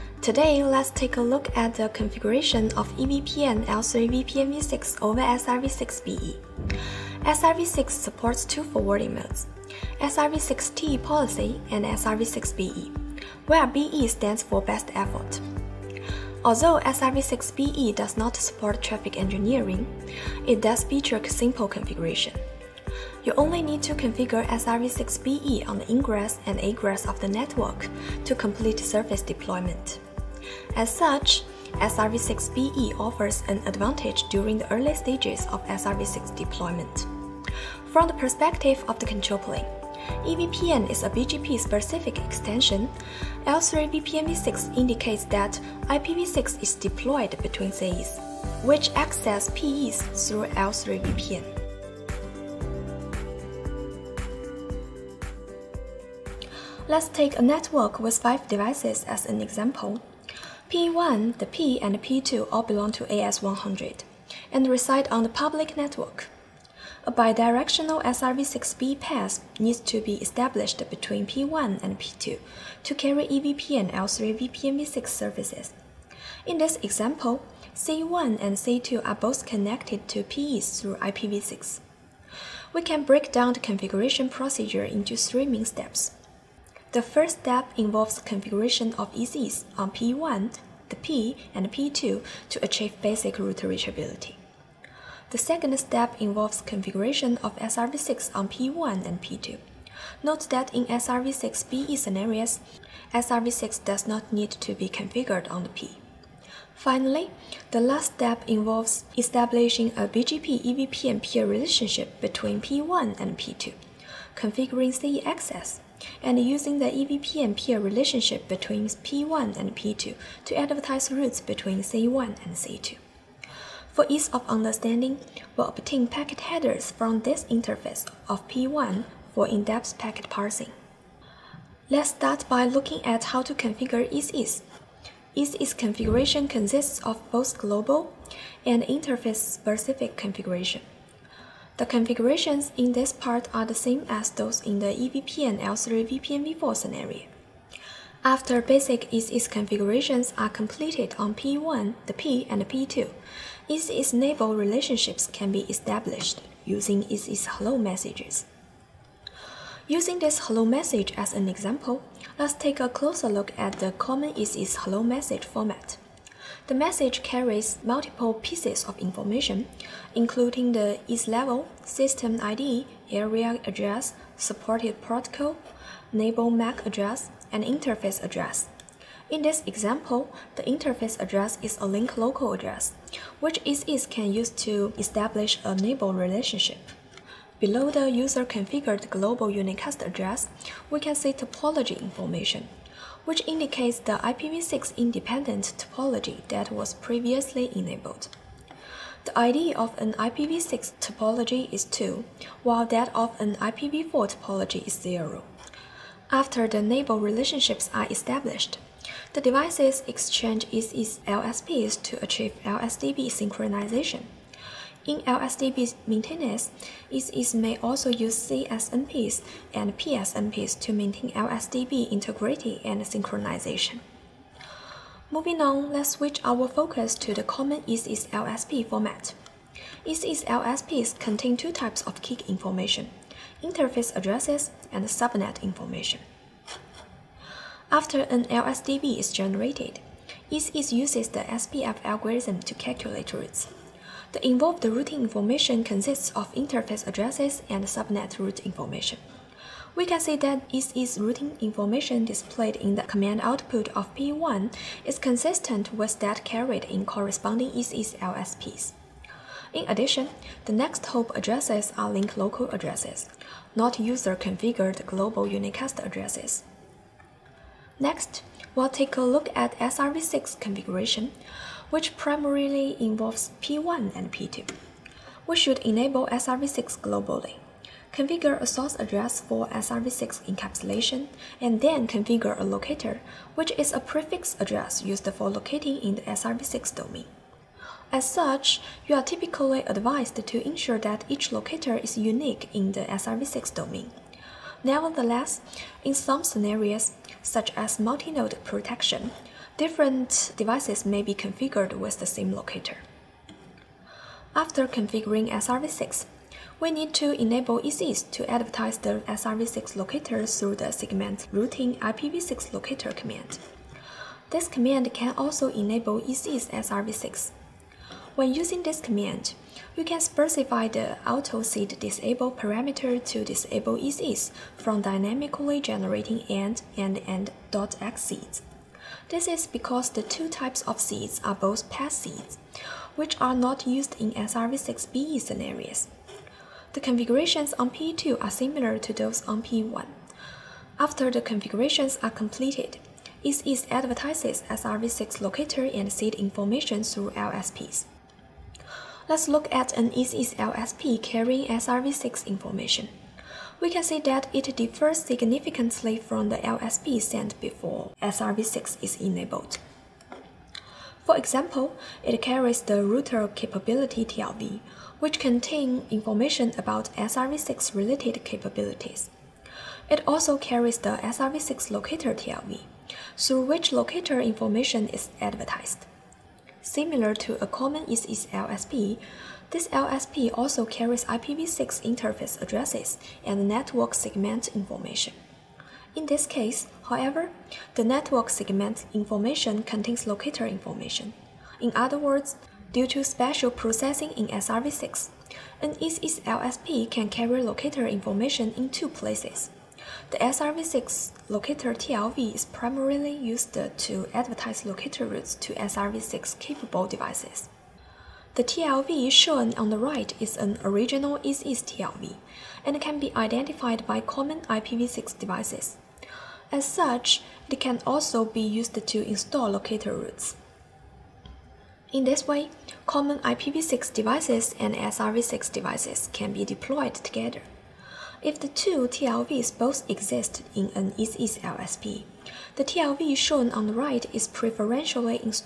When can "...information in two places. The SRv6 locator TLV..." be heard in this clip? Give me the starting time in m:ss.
6:38.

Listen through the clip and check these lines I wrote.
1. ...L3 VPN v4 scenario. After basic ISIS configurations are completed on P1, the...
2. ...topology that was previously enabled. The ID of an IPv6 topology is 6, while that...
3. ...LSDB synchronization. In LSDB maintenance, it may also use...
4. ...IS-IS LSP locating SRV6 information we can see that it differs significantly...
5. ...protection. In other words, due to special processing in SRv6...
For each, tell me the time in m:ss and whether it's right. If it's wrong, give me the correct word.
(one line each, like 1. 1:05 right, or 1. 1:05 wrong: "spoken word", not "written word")
1. 2:25 right
2. 3:15 wrong: "2", not "6"
3. 3:32 right
4. 5:50 wrong: "carrying", not "locating"
5. 6:30 wrong: "information", not "protection".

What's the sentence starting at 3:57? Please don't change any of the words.
After an LSDB is generated, IS-IS uses the SPF algorithm to calculate routes.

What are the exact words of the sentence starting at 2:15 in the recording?
IS-IS configuration consists of both global and interface-specific configuration.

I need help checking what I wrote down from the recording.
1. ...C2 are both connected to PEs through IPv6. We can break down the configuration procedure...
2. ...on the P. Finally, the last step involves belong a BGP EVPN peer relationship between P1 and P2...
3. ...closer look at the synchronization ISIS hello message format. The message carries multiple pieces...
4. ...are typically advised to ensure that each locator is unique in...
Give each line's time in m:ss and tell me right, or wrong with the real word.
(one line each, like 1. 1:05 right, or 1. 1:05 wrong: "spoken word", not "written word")
1. 1:18 right
2. 1:45 wrong: "establishing", not "belong"
3. 2:42 wrong: "common", not "synchronization"
4. 4:49 right.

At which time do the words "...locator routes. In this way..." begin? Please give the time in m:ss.
6:59.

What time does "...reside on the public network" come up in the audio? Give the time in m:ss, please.
1:04.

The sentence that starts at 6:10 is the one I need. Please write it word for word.
It also carries the SRv6 locator TLV, through which locator information is advertised.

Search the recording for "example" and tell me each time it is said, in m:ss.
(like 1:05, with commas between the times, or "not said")
0:59, 1:16, 2:41, 2:59, 6:01.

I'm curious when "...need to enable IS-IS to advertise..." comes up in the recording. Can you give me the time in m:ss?
5:06.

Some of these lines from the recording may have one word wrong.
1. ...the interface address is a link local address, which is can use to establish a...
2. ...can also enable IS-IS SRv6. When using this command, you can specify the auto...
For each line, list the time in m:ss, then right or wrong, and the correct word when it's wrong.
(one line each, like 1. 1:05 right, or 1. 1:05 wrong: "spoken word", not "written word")
1. 3:00 right
2. 5:15 right.